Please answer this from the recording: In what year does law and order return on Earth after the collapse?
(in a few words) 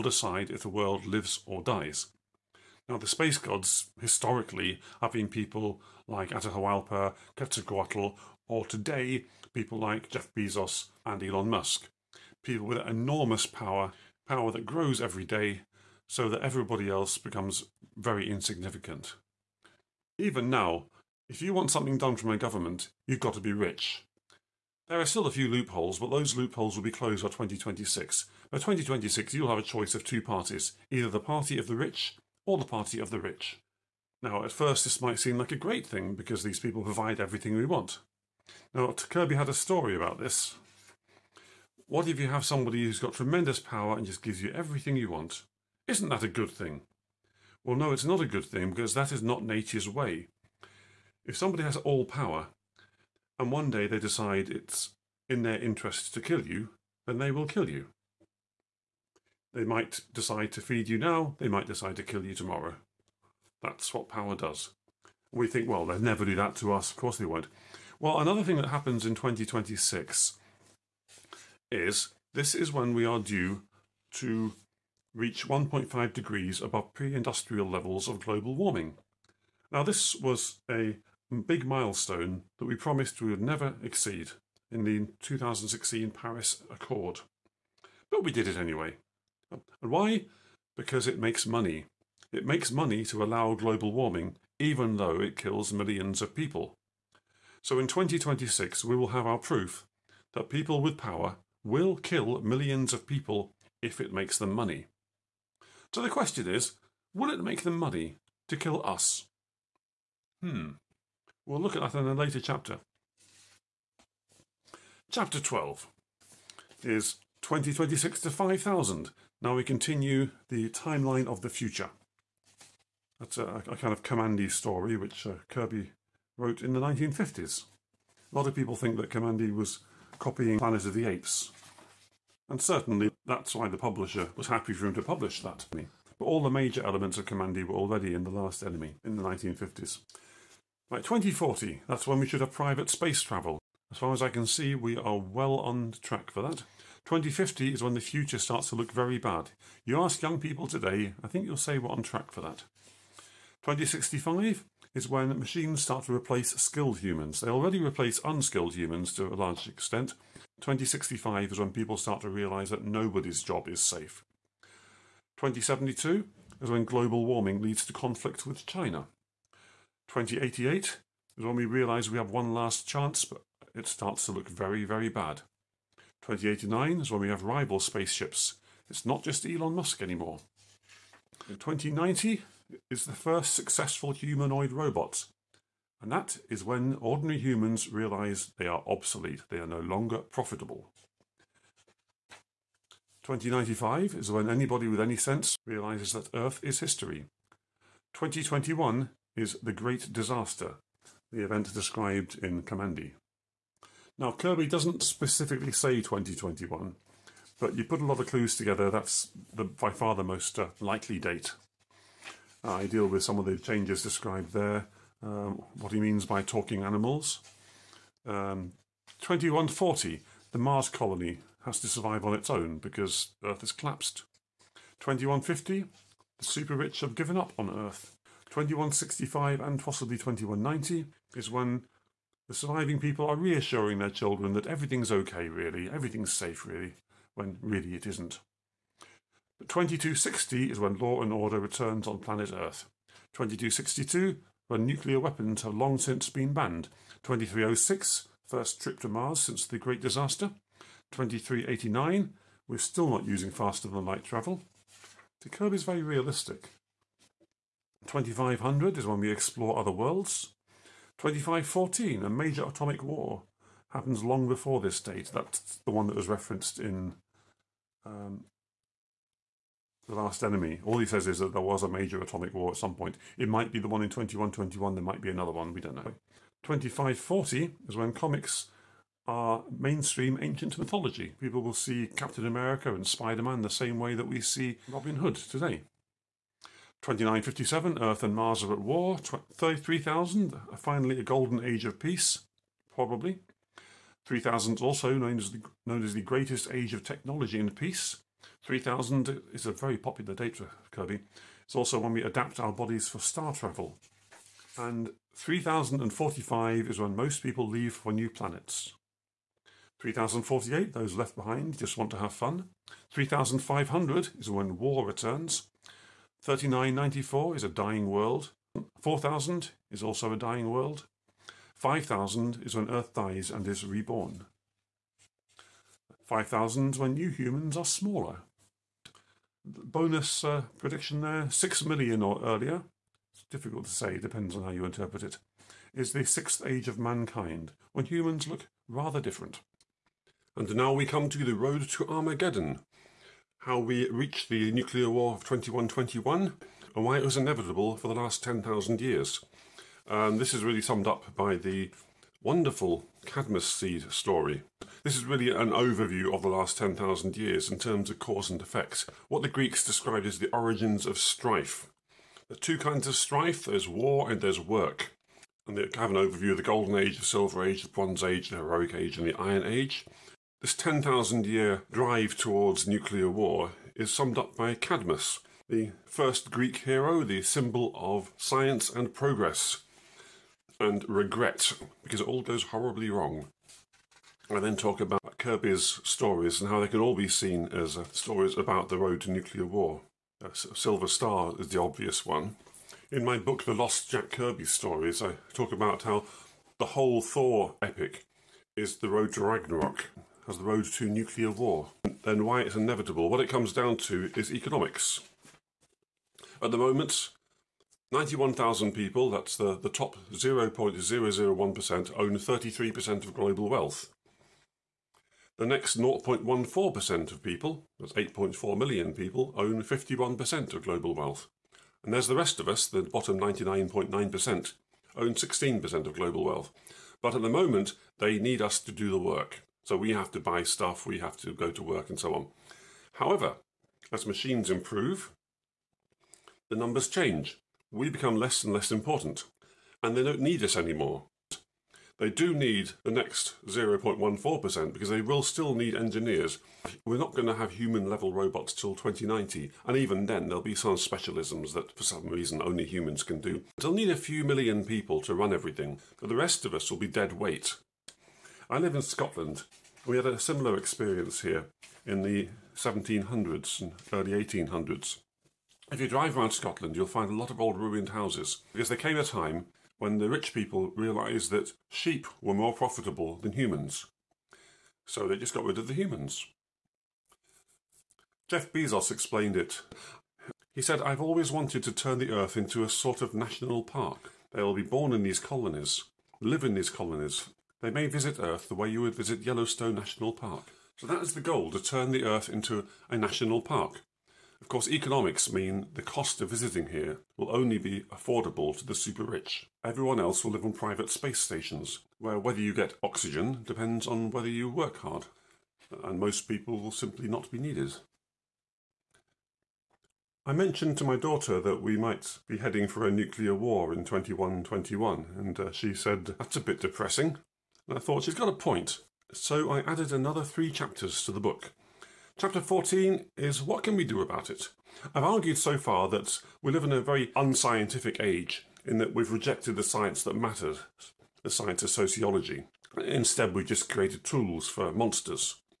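2260.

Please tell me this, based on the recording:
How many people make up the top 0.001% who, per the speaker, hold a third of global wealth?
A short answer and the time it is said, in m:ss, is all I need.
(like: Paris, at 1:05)
91,000, at 6:48.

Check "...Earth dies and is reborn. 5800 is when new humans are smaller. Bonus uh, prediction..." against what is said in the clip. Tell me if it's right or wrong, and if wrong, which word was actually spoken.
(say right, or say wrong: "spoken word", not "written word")
wrong: "5000", not "5800".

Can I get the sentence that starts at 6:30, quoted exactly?
Uh, Silver Star is the obvious one.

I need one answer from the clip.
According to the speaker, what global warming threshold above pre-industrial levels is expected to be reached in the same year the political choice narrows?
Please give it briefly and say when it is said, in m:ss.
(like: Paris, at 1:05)
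1.5 degrees, at 1:15.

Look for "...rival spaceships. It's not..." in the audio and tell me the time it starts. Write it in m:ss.
2:57.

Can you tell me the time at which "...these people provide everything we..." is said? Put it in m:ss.
0:36.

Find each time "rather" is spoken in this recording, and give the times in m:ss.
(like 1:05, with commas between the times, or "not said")
5:38.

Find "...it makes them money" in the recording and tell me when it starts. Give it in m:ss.
1:43.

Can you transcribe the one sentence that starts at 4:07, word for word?
2306, first trip to Mars since the Great Disaster.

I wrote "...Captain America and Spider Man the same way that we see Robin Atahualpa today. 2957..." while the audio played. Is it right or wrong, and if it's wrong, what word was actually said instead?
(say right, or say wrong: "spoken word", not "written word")
wrong: "Hood", not "Atahualpa".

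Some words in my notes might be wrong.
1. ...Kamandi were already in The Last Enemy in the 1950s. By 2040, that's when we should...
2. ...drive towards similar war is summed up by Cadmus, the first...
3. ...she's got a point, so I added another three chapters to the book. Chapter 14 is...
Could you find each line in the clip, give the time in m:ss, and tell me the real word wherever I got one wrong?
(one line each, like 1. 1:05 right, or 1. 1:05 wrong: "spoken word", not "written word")
1. 2:17 right
2. 6:11 wrong: "nuclear", not "similar"
3. 8:38 right.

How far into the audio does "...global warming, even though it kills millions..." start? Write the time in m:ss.
1:33.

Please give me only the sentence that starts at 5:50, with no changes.
And this is really summed up by the wonderful Cadmus seed story.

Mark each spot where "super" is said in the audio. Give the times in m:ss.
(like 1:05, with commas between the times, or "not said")
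3:46, 8:18.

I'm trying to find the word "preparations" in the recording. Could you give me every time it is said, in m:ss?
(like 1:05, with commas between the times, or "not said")
not said.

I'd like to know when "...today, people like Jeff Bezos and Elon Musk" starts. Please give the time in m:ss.
0:08.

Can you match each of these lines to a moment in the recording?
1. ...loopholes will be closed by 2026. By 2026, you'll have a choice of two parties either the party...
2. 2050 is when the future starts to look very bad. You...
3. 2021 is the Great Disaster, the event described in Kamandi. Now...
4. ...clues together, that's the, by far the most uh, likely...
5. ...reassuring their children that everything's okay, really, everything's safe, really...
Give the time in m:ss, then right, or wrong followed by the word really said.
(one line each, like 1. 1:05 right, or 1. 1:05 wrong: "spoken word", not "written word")
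1. 0:26 right
2. 2:27 right
3. 3:18 right
4. 3:28 right
5. 3:53 right.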